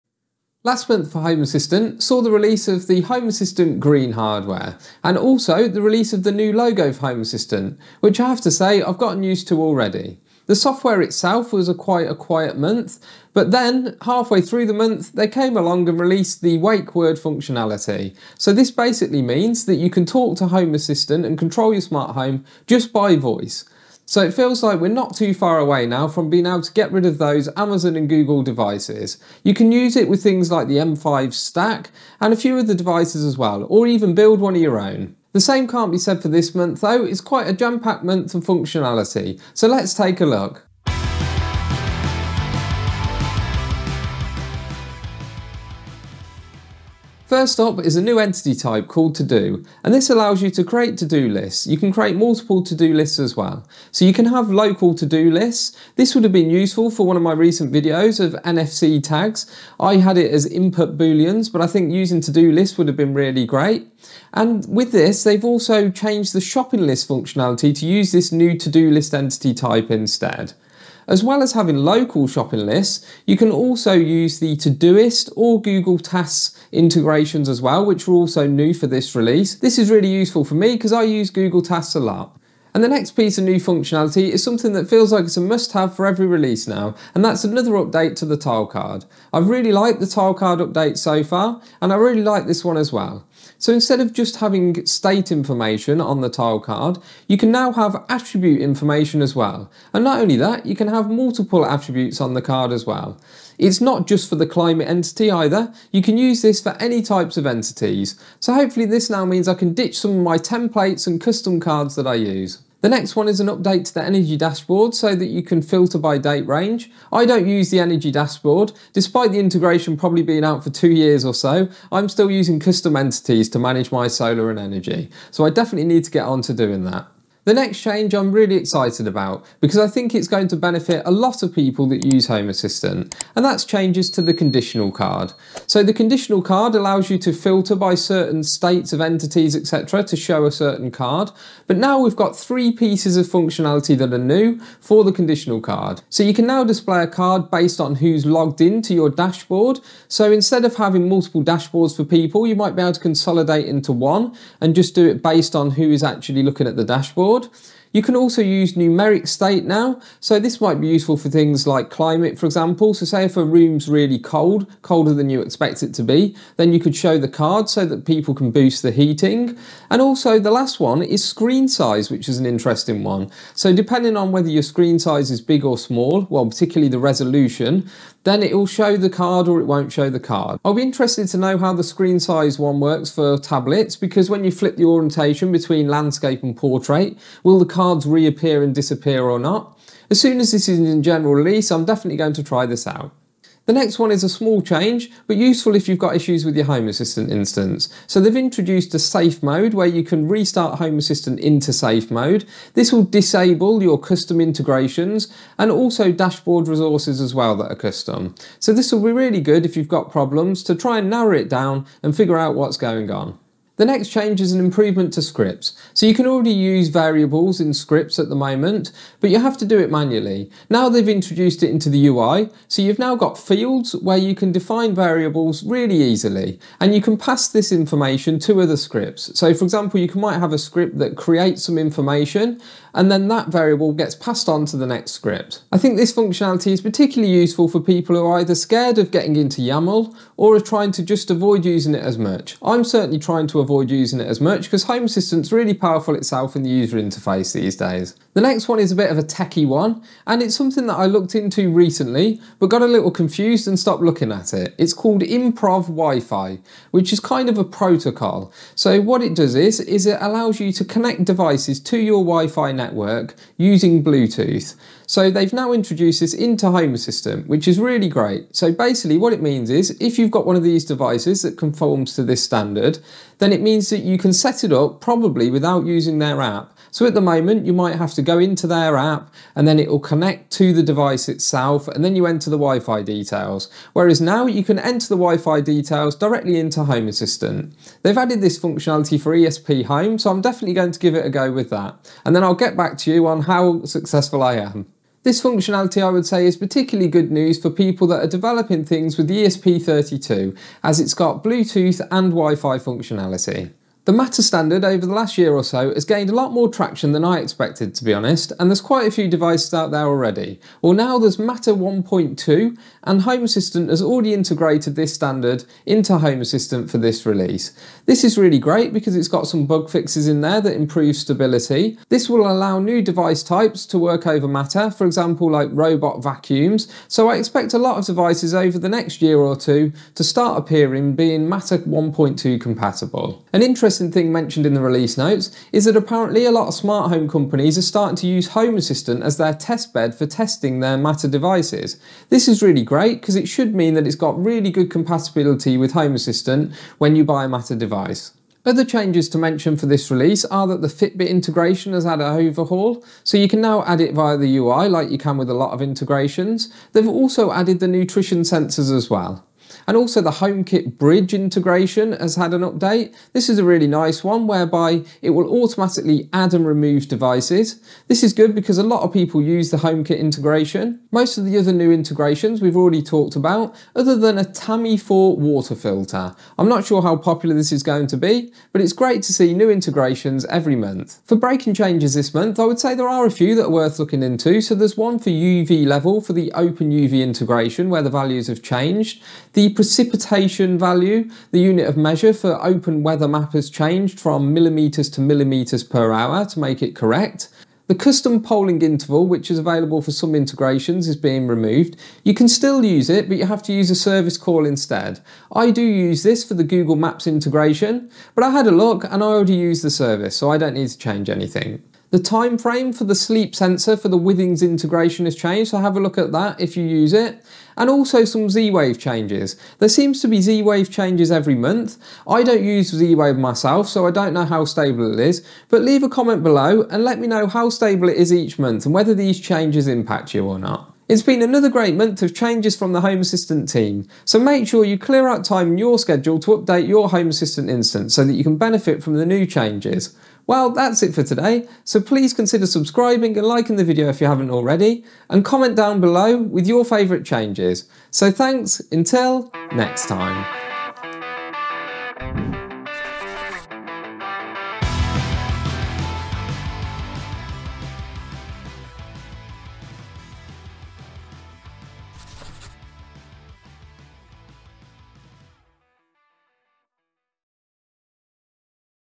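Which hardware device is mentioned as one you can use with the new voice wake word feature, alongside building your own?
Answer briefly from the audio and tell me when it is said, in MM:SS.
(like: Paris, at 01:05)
M5Stack, at 00:30.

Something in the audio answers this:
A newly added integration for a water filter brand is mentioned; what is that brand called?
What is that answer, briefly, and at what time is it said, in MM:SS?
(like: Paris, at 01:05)
Tami4, at 06:14.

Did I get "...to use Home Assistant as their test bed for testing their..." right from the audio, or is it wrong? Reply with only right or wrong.
right.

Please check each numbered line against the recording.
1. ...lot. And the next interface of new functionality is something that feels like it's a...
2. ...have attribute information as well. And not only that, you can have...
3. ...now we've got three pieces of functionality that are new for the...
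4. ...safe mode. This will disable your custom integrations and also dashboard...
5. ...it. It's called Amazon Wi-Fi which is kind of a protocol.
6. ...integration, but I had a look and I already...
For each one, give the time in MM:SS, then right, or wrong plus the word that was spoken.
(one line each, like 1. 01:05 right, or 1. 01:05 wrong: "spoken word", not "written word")
1. 01:21 wrong: "piece", not "interface"
2. 01:37 right
3. 02:21 right
4. 03:21 right
5. 04:14 wrong: "Improv", not "Amazon"
6. 06:47 right.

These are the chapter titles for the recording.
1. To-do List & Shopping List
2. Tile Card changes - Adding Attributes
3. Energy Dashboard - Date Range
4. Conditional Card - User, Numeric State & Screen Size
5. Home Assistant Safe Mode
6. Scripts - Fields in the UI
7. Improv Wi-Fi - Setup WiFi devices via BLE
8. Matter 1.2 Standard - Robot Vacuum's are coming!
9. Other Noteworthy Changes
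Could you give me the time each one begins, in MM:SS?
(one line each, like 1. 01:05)
1. 00:47
2. 01:22
3. 01:52
4. 02:07
5. 03:13
6. 03:33
7. 04:08
8. 05:03
9. 05:48.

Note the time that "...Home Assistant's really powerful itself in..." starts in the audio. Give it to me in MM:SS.
04:04.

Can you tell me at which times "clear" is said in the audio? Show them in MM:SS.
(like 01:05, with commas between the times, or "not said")
07:14.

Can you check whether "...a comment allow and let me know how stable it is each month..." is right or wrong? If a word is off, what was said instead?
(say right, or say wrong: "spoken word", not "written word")
wrong: "below", not "allow".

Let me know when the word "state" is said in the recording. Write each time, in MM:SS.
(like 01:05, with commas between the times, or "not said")
01:34, 02:18, 02:39.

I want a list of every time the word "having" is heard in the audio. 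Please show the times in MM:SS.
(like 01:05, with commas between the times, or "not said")
01:11, 01:34, 02:30.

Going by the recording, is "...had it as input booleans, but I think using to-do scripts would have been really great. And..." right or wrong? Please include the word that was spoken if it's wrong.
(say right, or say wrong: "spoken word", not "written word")
wrong: "lists", not "scripts".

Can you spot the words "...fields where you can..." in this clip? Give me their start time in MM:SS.
03:43.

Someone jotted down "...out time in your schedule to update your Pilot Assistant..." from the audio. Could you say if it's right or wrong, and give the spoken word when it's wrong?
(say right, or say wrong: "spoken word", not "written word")
wrong: "Home", not "Pilot".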